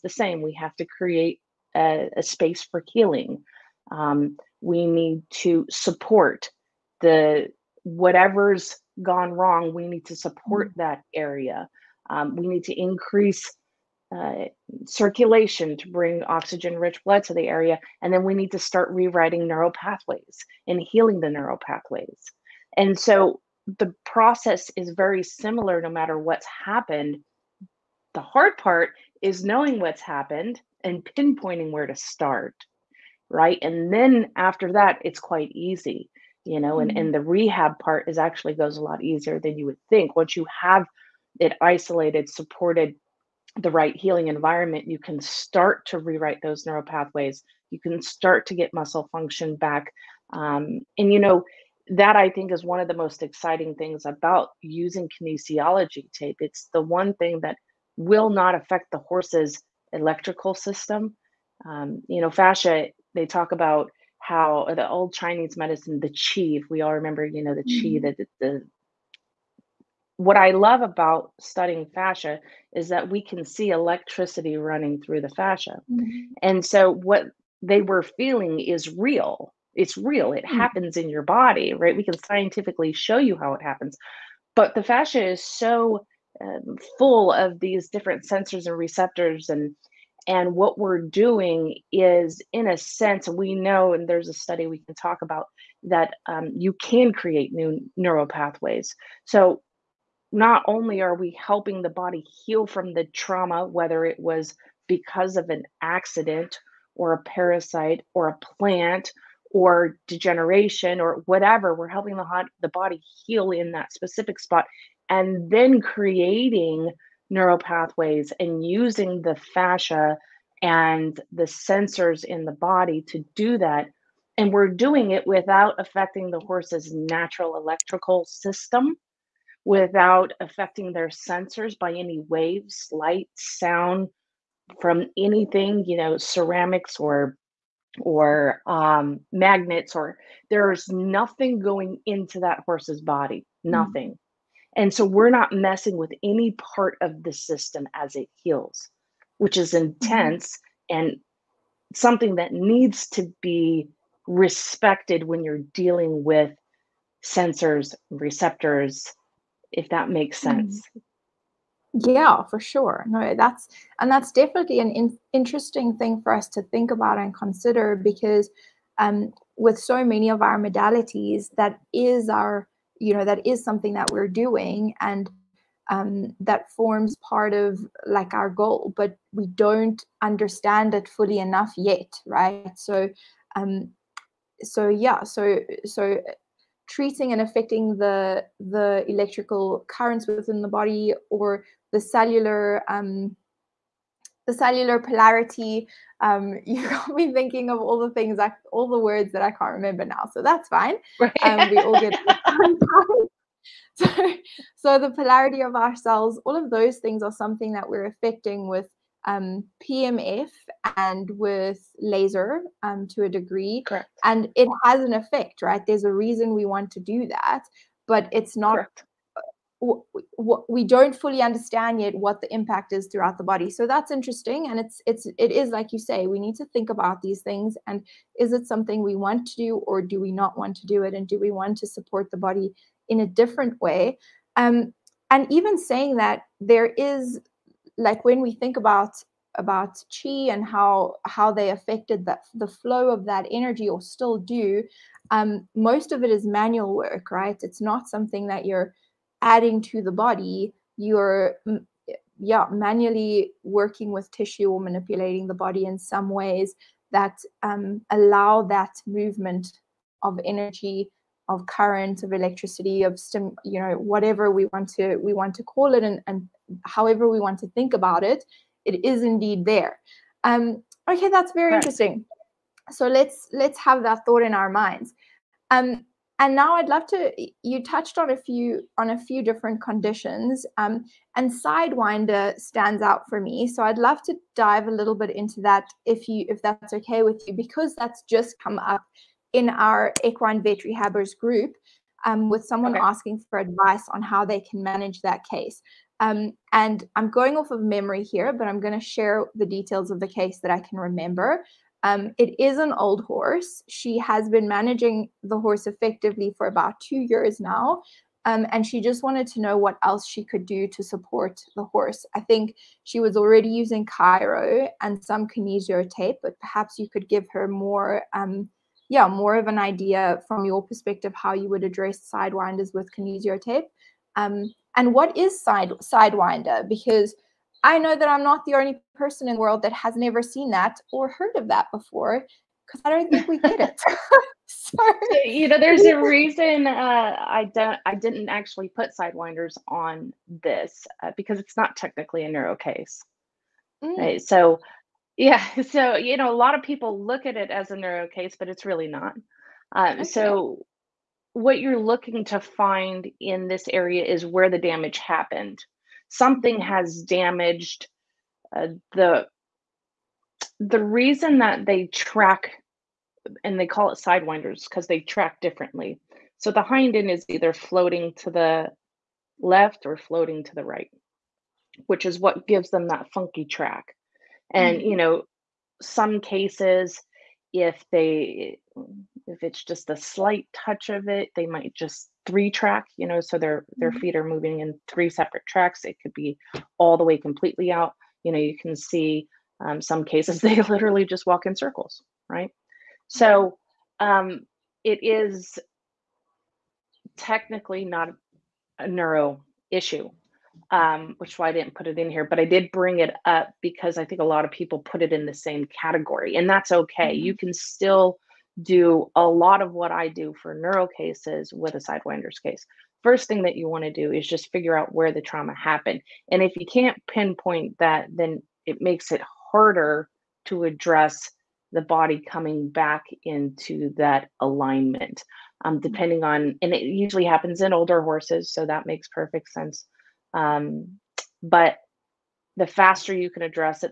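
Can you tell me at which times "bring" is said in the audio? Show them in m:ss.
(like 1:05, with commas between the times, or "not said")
0:15, 6:42.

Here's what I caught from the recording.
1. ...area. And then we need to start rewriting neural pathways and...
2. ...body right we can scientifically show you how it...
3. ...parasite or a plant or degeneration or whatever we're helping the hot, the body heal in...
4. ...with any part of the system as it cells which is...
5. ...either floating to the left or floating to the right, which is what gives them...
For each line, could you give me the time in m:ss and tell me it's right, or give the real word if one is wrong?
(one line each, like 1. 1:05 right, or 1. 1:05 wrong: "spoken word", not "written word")
1. 0:17 right
2. 1:21 right
3. 1:47 right
4. 2:25 wrong: "heals", not "cells"
5. 6:07 right.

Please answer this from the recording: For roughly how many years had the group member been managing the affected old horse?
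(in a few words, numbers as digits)
2 years.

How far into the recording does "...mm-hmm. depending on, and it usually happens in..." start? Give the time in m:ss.
7:05.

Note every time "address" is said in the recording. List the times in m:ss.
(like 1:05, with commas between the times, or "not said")
5:21, 7:00.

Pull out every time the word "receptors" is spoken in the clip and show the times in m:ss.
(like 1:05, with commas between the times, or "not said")
1:28, 2:38.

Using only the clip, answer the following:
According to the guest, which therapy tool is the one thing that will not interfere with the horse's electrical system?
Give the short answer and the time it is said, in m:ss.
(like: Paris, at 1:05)
kinesiology tape, at 0:55.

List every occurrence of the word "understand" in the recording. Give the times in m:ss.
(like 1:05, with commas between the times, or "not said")
3:00, 3:41.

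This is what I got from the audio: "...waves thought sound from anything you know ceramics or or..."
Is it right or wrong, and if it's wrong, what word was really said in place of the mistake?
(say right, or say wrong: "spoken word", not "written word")
wrong: "light", not "thought".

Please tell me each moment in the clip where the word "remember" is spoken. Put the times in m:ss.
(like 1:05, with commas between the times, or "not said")
1:06, 3:19, 5:00.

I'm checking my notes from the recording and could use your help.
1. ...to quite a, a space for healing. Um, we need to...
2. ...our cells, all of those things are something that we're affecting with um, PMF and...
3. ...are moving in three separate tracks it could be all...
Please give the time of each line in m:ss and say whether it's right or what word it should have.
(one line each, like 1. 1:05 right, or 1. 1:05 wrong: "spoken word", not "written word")
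1. 0:00 wrong: "create", not "quite"
2. 3:25 right
3. 6:24 right.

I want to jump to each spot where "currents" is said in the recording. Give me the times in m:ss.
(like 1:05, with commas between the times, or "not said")
3:09, 4:21.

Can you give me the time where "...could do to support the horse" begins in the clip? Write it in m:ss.
5:10.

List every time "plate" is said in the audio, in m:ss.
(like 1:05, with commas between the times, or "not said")
not said.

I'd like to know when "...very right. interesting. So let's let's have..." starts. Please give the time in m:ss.
4:31.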